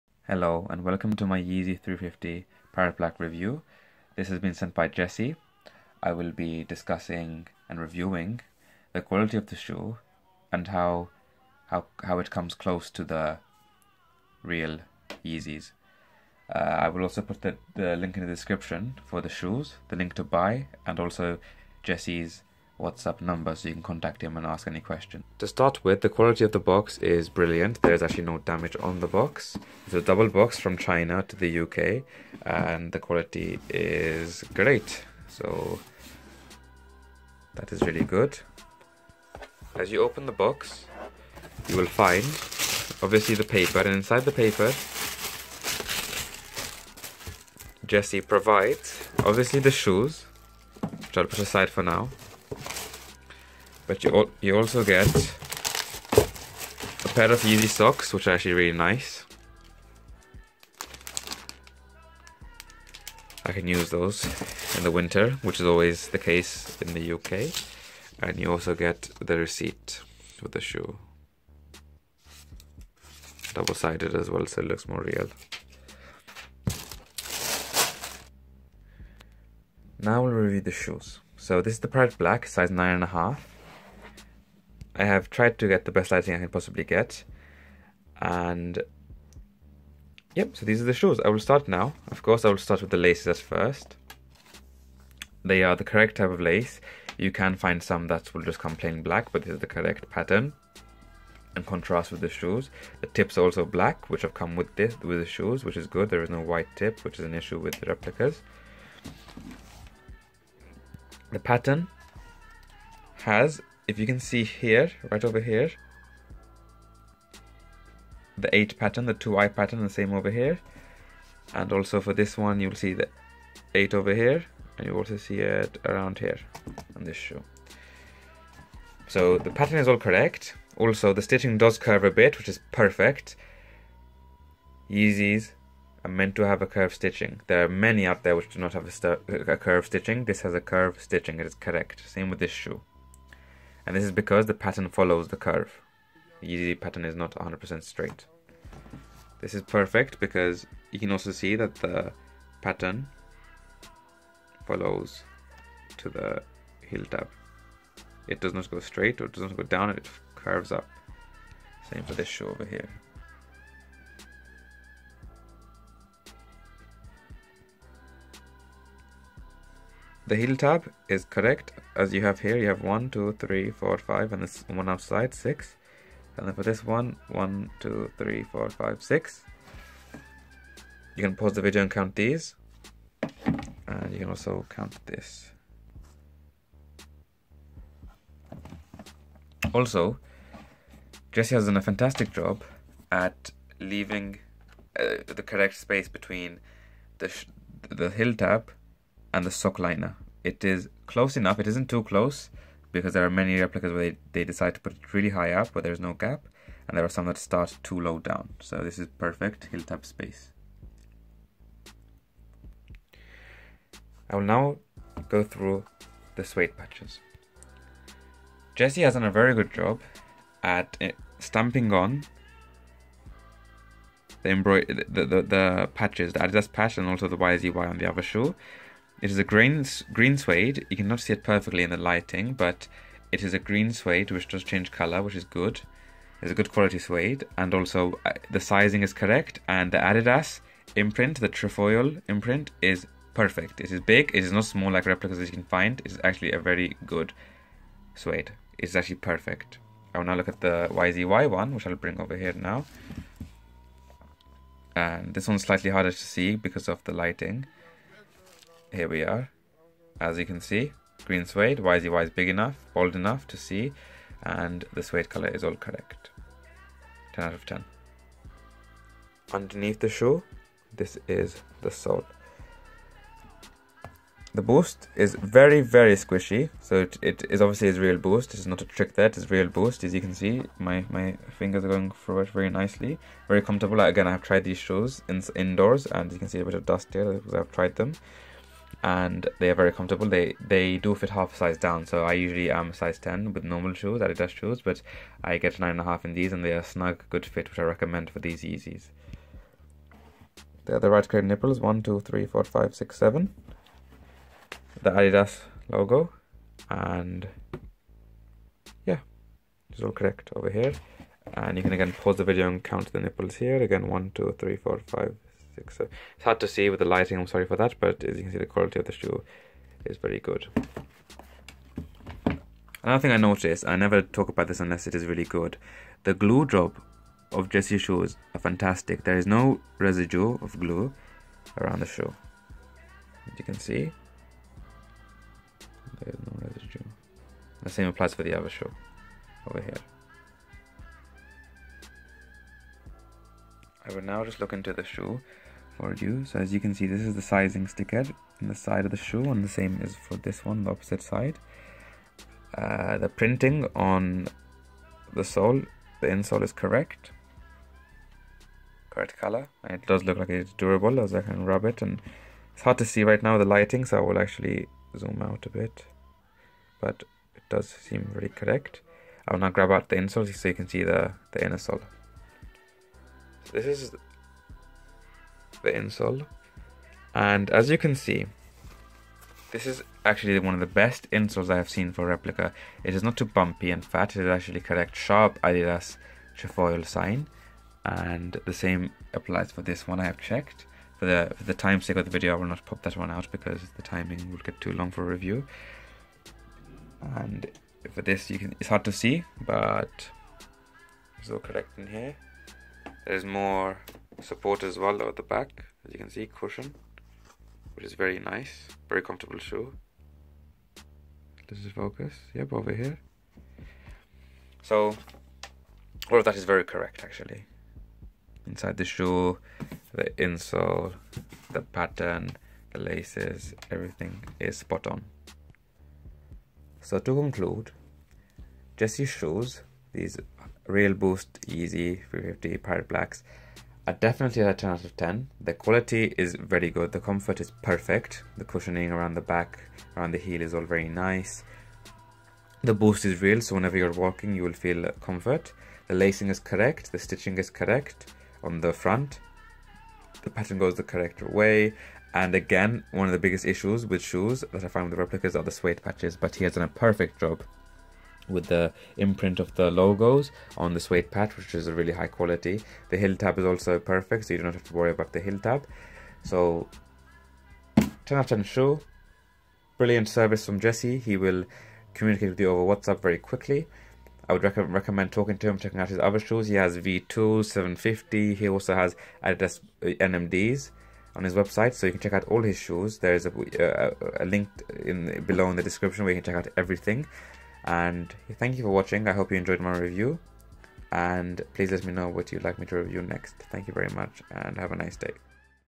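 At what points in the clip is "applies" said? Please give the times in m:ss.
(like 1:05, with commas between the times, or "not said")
5:38, 6:29.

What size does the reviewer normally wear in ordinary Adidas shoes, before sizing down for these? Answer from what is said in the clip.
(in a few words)
10.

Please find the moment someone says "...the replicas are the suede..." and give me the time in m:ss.
7:35.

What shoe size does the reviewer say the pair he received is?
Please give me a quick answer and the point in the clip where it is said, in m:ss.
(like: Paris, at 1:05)
9.5, at 1:22.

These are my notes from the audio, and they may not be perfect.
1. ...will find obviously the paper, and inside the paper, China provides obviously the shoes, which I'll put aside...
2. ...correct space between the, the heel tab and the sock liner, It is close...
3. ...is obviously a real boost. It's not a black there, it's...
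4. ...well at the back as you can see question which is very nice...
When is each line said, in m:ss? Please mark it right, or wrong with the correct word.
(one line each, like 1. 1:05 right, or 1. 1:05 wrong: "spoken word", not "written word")
1. 0:41 wrong: "Jessie", not "China"
2. 3:15 right
3. 4:37 wrong: "trick", not "black"
4. 6:44 wrong: "cushion", not "question".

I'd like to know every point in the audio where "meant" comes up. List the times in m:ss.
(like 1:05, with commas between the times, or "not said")
2:16.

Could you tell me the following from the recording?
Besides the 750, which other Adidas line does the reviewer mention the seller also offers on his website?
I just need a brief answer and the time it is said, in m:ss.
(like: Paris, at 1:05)
NMDs, at 8:00.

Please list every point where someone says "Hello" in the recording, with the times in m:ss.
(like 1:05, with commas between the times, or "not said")
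0:00.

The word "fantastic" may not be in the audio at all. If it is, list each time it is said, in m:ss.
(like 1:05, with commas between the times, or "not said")
3:11, 5:28.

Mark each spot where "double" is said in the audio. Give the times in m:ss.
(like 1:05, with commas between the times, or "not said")
0:30, 1:13.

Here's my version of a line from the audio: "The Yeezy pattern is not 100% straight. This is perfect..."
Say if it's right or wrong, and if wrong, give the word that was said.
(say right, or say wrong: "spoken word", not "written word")
right.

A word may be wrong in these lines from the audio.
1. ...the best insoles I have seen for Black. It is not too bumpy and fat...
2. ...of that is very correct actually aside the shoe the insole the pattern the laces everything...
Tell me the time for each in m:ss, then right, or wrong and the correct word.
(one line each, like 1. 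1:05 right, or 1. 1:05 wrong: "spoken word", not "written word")
1. 6:20 wrong: "Replica", not "Black"
2. 6:56 wrong: "inside", not "aside".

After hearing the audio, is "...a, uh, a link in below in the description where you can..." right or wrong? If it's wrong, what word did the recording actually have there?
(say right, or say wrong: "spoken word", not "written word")
right.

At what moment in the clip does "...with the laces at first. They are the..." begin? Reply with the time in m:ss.
1:32.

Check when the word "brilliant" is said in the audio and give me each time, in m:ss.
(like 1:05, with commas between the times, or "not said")
0:27, 7:49.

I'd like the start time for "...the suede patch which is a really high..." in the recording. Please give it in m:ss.
7:40.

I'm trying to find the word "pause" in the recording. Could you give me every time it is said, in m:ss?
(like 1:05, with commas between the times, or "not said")
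3:01, 5:12.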